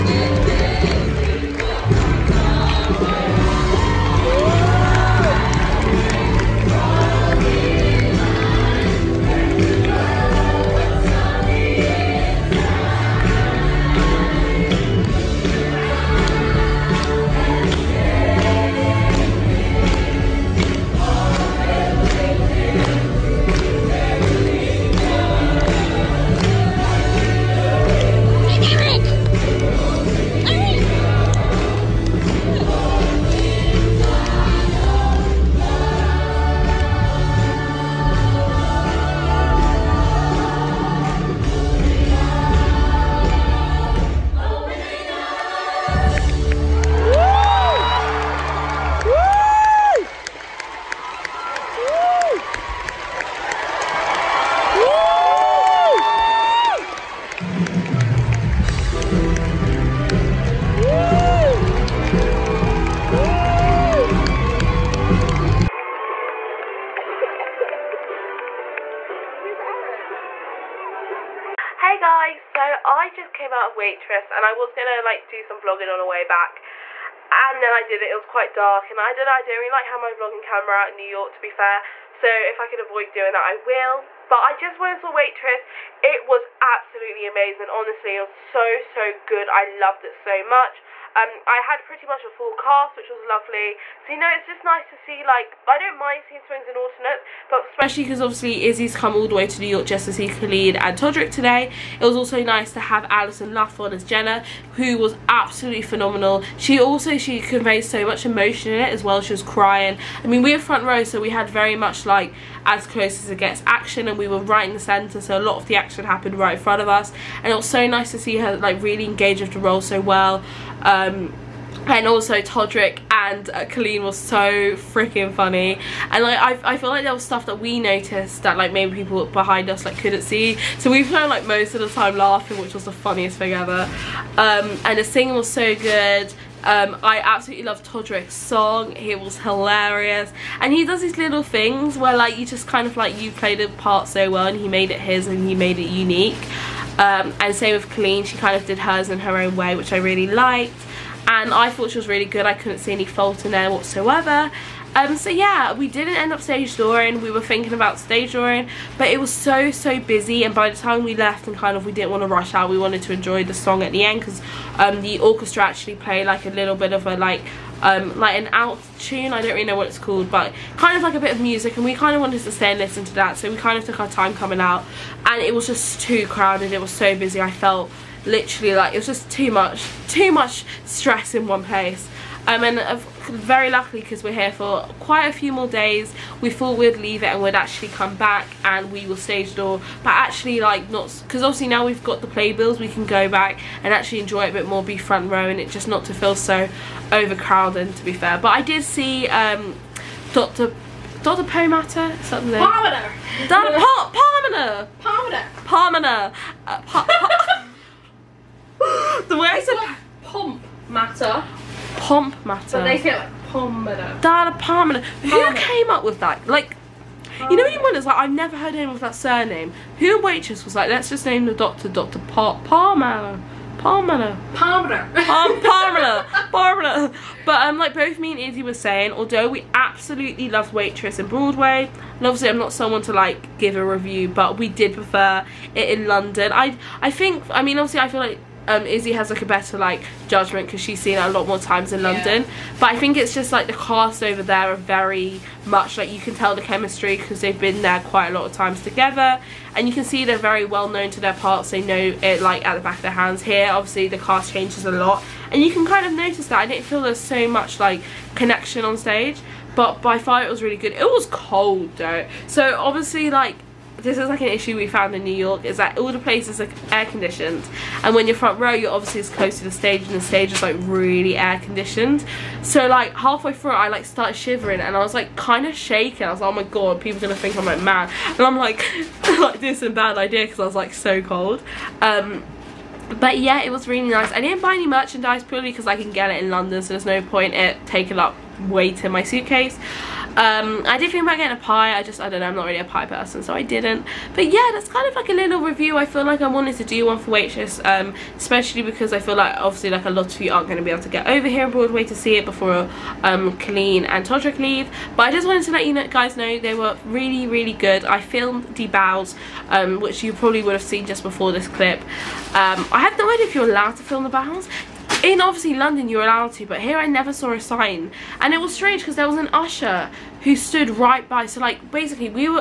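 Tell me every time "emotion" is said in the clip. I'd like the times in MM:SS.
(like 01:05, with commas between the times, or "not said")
01:48.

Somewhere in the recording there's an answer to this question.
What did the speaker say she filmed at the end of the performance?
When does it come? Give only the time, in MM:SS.
05:08.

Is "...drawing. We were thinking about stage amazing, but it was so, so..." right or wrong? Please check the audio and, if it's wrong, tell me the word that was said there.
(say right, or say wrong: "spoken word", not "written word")
wrong: "drawing", not "amazing".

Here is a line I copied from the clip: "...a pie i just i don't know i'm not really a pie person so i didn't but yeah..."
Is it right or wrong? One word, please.
right.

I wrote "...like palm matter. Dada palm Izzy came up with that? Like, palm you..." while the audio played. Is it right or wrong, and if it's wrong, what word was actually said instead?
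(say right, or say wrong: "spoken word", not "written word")
wrong: "Who", not "Izzy".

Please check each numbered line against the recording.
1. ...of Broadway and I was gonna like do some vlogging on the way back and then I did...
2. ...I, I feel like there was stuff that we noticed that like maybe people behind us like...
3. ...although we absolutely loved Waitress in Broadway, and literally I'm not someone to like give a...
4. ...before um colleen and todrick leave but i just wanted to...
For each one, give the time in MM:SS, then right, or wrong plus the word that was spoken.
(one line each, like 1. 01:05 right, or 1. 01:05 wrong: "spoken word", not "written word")
1. 01:13 wrong: "Waitress", not "Broadway"
2. 02:06 right
3. 03:49 wrong: "obviously", not "literally"
4. 05:02 right.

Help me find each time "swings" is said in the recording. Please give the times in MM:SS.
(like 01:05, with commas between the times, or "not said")
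01:36.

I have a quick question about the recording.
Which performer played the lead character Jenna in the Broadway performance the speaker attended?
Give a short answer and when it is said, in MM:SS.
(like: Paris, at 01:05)
Alison Luff, at 01:43.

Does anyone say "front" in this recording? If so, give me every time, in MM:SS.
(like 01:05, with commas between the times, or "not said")
01:50, 01:56, 03:14, 04:28.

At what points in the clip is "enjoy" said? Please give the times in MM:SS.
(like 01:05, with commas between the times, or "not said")
02:43, 03:14.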